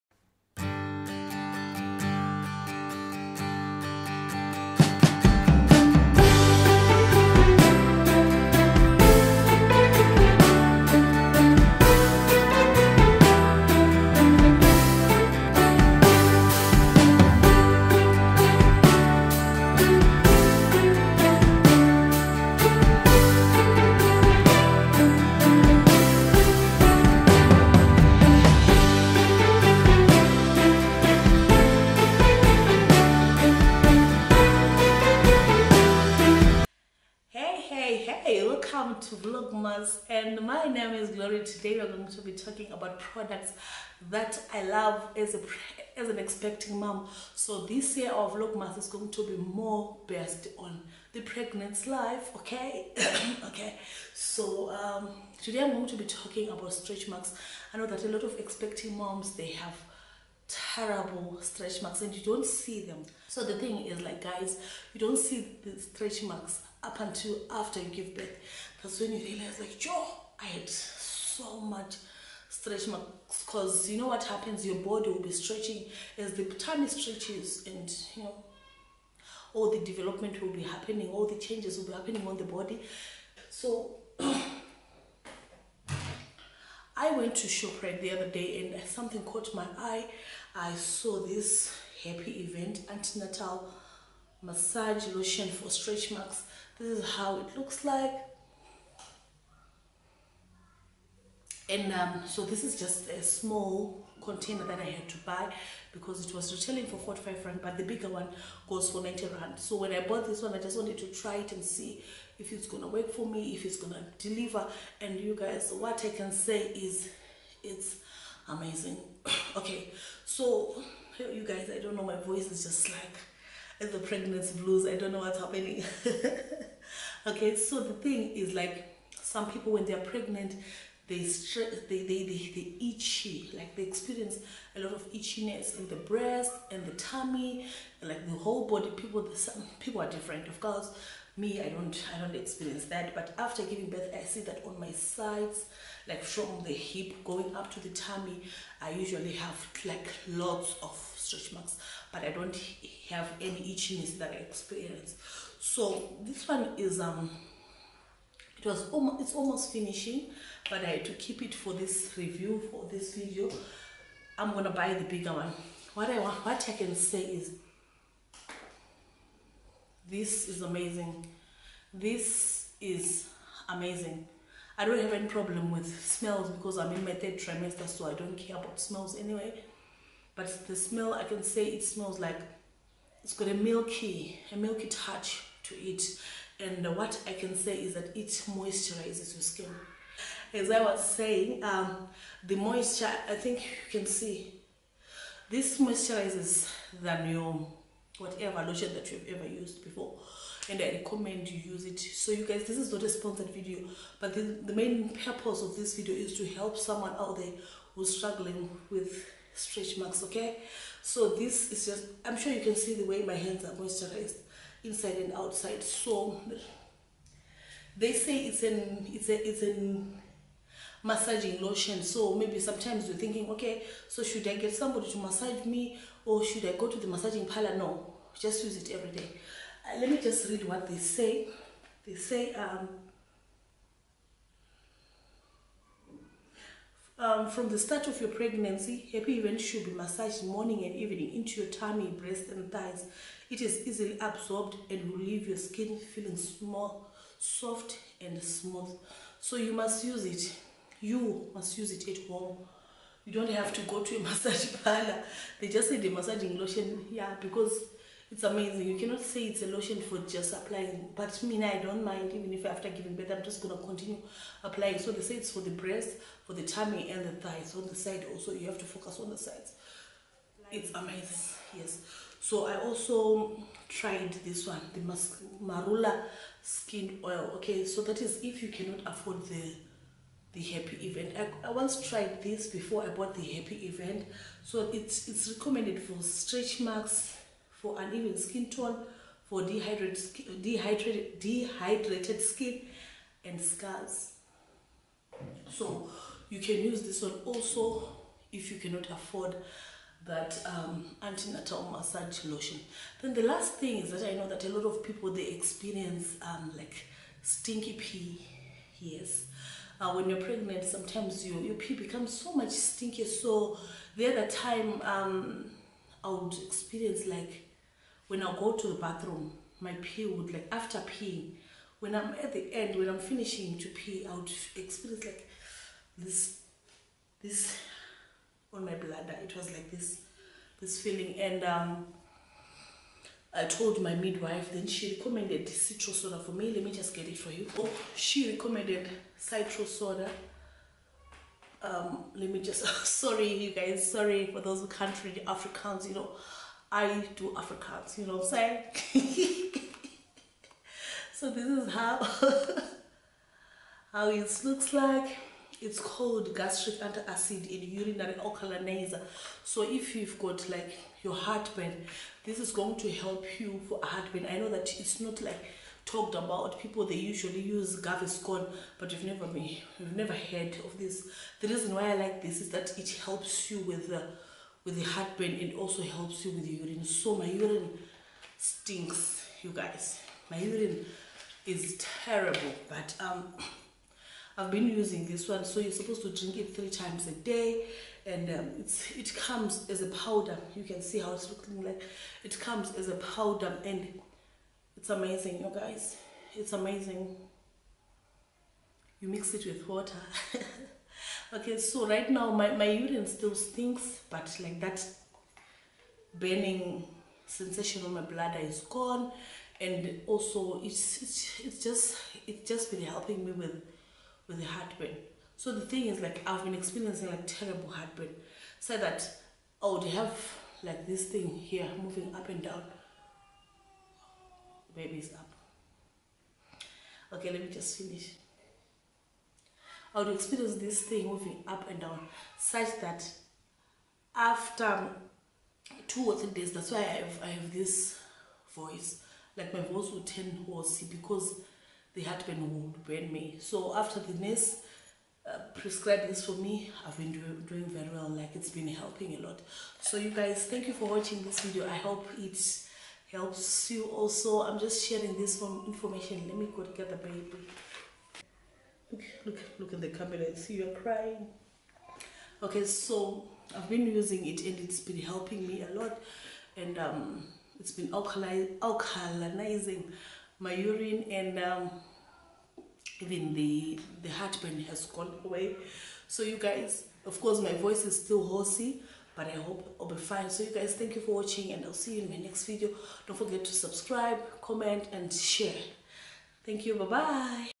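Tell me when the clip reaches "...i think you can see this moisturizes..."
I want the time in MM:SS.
03:13.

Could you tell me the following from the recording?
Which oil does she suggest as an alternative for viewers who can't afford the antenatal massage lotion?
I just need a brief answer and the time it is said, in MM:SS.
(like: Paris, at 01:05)
Marula Skin Oil, at 04:35.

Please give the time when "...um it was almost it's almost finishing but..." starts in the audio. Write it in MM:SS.
02:36.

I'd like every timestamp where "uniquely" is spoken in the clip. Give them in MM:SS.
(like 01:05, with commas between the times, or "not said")
not said.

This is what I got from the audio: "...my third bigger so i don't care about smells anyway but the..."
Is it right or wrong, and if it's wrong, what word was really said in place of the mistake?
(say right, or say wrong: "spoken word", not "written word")
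wrong: "trimester", not "bigger".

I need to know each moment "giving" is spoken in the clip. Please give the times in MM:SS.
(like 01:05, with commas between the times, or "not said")
02:23, 04:22.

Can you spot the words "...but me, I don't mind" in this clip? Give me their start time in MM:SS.
04:21.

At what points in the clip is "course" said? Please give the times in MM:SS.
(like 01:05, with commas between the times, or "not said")
02:20, 07:57.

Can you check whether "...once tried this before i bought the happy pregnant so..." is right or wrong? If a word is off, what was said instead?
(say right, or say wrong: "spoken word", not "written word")
wrong: "event", not "pregnant".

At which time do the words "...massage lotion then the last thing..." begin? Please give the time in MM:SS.
05:01.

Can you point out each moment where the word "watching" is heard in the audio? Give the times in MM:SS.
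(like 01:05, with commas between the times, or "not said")
07:31, 08:01.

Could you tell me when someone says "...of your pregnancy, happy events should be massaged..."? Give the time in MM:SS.
03:58.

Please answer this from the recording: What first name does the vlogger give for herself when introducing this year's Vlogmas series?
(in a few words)
Glory.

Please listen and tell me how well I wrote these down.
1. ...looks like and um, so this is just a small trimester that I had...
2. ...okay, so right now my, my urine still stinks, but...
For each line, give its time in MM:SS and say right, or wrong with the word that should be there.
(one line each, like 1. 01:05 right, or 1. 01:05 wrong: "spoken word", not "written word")
1. 01:37 wrong: "container", not "trimester"
2. 06:41 right.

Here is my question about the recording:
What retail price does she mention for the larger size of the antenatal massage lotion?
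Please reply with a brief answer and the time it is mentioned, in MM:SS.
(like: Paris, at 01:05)
90 rand, at 01:49.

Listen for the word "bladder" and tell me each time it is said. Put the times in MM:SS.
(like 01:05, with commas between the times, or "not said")
05:28, 06:48.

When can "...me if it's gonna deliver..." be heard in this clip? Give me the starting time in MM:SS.
01:53.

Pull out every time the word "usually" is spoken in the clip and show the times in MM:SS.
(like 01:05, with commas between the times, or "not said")
02:28, 06:07.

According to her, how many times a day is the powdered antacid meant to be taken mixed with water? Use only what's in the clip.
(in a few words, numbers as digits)
3 times.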